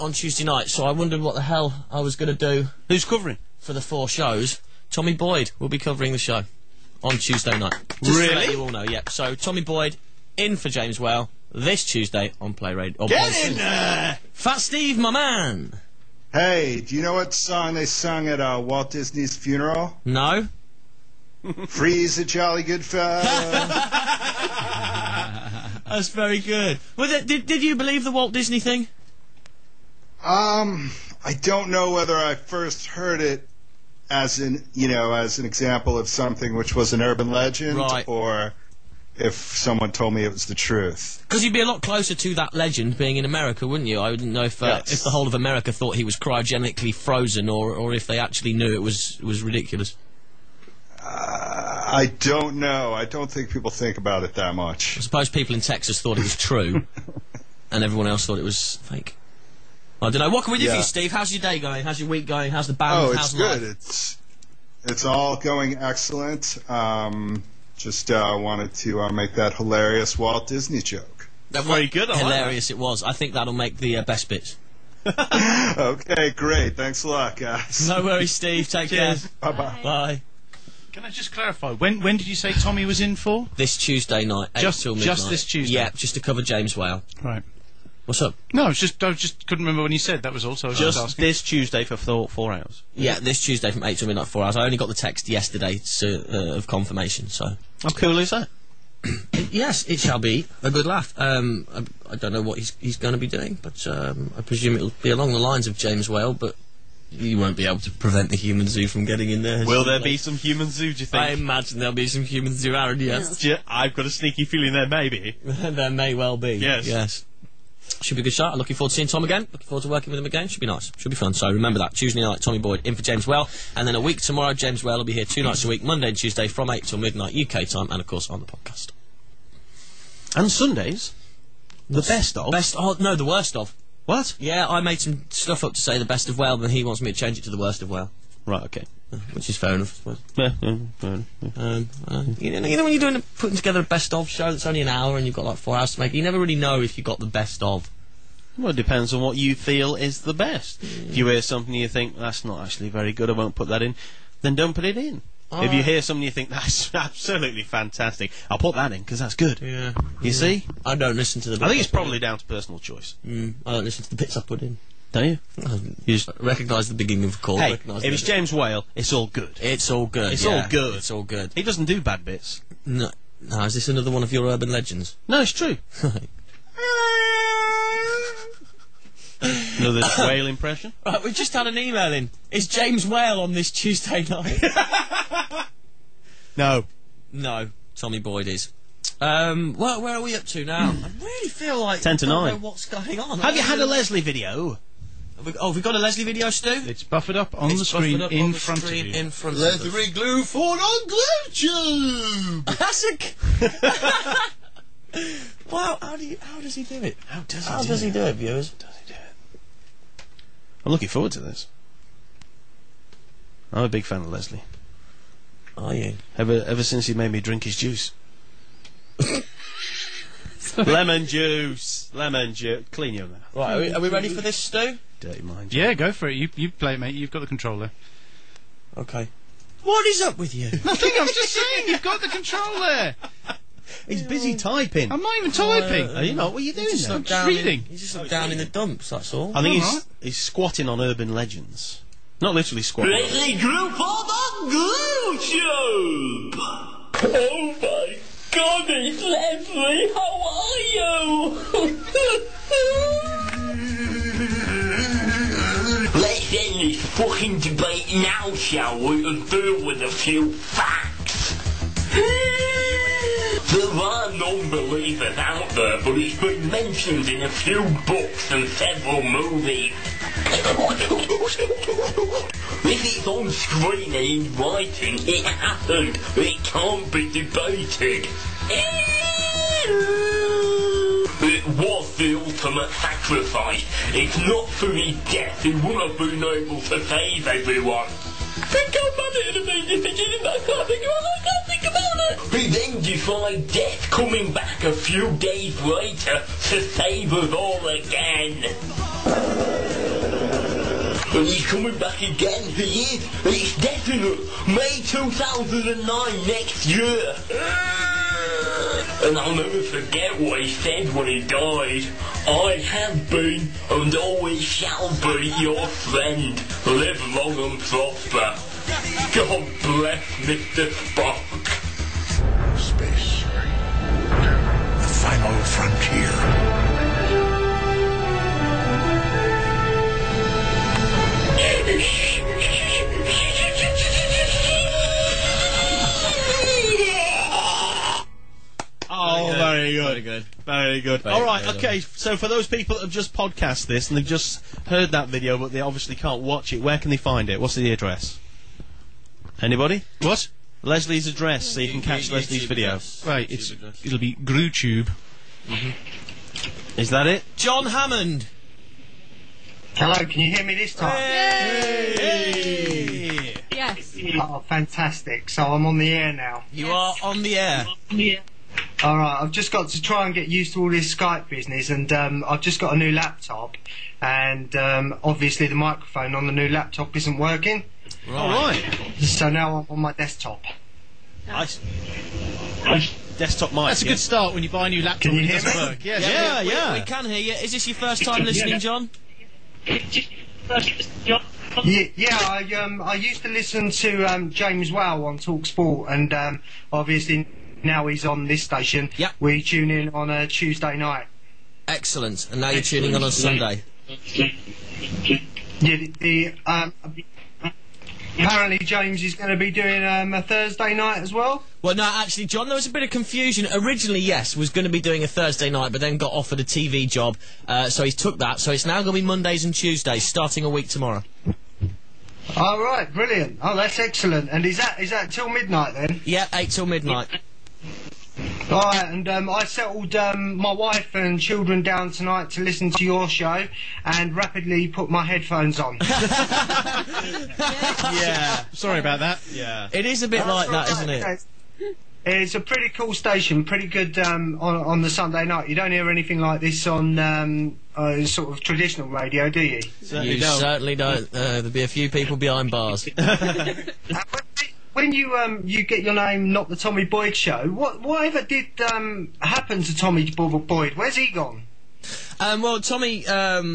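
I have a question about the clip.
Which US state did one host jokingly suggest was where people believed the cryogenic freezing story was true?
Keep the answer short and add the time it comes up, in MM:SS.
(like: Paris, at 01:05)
Texas, at 00:55.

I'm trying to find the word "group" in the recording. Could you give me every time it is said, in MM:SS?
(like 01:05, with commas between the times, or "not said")
04:03.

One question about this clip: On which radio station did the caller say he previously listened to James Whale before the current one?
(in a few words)
Talksport.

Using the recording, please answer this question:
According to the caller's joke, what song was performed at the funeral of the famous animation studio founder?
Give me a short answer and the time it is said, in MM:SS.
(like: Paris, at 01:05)
Freeze a jolly good fellow, at 00:21.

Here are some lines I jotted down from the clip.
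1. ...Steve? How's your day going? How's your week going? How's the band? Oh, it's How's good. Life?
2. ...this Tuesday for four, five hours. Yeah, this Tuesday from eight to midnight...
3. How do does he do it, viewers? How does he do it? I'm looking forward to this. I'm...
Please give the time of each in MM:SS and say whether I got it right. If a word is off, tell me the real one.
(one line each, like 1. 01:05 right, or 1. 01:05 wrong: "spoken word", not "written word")
1. 01:00 right
2. 01:31 wrong: "four", not "five"
3. 03:27 right.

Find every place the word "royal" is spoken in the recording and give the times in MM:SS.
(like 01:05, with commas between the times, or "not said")
not said.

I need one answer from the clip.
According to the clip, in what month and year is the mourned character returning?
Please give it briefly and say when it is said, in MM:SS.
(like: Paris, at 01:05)
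May 2009, at 05:04.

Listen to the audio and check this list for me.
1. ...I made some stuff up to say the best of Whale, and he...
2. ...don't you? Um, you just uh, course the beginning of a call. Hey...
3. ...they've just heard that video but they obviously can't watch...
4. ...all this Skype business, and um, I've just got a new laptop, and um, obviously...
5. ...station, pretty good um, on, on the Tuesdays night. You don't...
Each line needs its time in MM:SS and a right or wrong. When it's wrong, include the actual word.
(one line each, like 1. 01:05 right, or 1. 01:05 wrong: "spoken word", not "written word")
1. 02:14 right
2. 02:45 wrong: "recognise", not "course"
3. 05:44 right
4. 06:10 right
5. 07:23 wrong: "Sunday", not "Tuesdays".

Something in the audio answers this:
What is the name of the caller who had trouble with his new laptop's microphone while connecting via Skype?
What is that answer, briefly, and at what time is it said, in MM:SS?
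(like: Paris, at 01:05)
John Hammond, at 05:57.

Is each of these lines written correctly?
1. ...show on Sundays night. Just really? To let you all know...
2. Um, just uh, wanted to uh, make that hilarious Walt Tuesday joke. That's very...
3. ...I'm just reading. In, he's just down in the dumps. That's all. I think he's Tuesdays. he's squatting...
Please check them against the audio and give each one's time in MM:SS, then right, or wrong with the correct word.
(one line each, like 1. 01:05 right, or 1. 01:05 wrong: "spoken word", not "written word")
1. 00:06 wrong: "Tuesday", not "Sundays"
2. 01:06 wrong: "Disney", not "Tuesday"
3. 03:57 wrong: "Alright", not "Tuesdays".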